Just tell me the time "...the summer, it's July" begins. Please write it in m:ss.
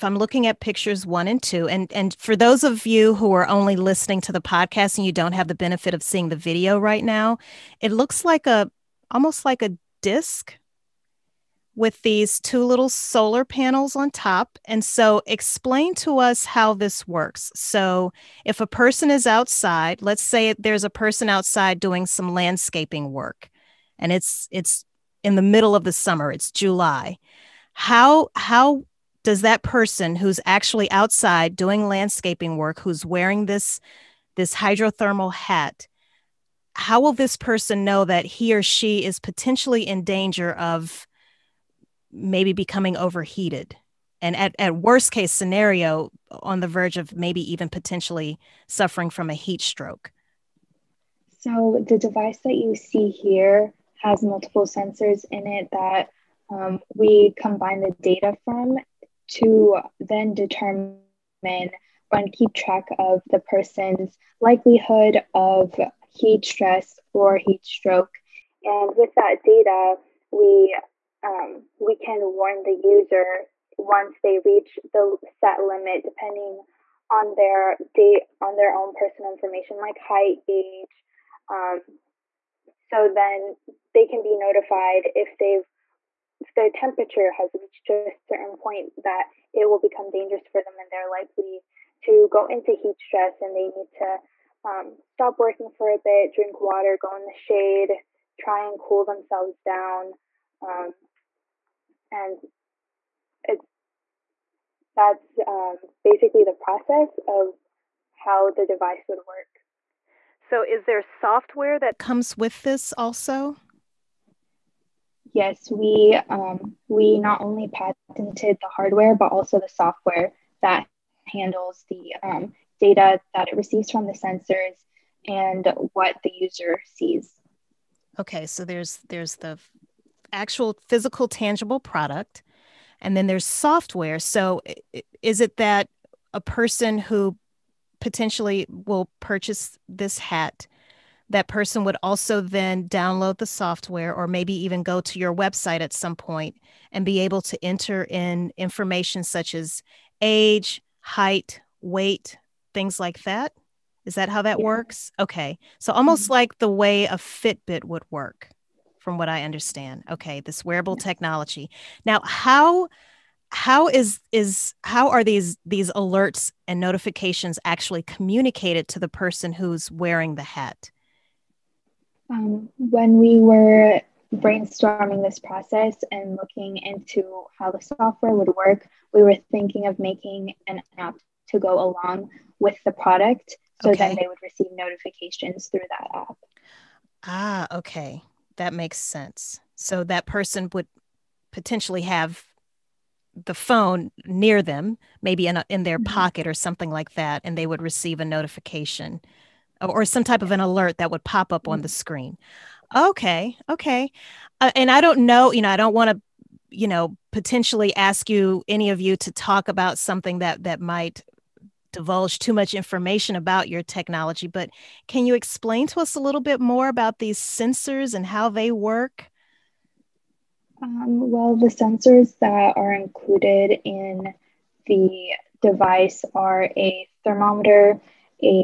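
0:25.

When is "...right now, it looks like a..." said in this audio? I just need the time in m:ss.
0:06.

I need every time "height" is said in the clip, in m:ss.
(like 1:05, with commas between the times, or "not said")
1:19, 2:30.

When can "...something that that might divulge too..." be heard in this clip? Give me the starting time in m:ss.
3:29.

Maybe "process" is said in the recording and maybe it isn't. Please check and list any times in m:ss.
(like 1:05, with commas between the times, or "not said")
1:46, 2:55.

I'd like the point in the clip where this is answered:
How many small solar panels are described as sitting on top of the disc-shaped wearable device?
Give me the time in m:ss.
0:12.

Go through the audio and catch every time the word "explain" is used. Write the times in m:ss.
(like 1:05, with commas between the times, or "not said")
0:15, 3:35.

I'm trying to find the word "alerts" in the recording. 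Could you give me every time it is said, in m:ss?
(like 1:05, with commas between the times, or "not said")
2:45, 3:20.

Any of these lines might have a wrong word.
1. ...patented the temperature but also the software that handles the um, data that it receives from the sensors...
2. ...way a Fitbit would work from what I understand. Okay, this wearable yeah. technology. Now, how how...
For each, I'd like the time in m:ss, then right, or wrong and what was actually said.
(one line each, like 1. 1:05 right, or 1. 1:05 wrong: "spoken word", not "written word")
1. 1:57 wrong: "hardware", not "temperature"
2. 2:36 right.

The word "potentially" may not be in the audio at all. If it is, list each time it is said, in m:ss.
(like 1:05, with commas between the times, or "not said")
0:39, 0:47, 2:17, 3:11, 3:27.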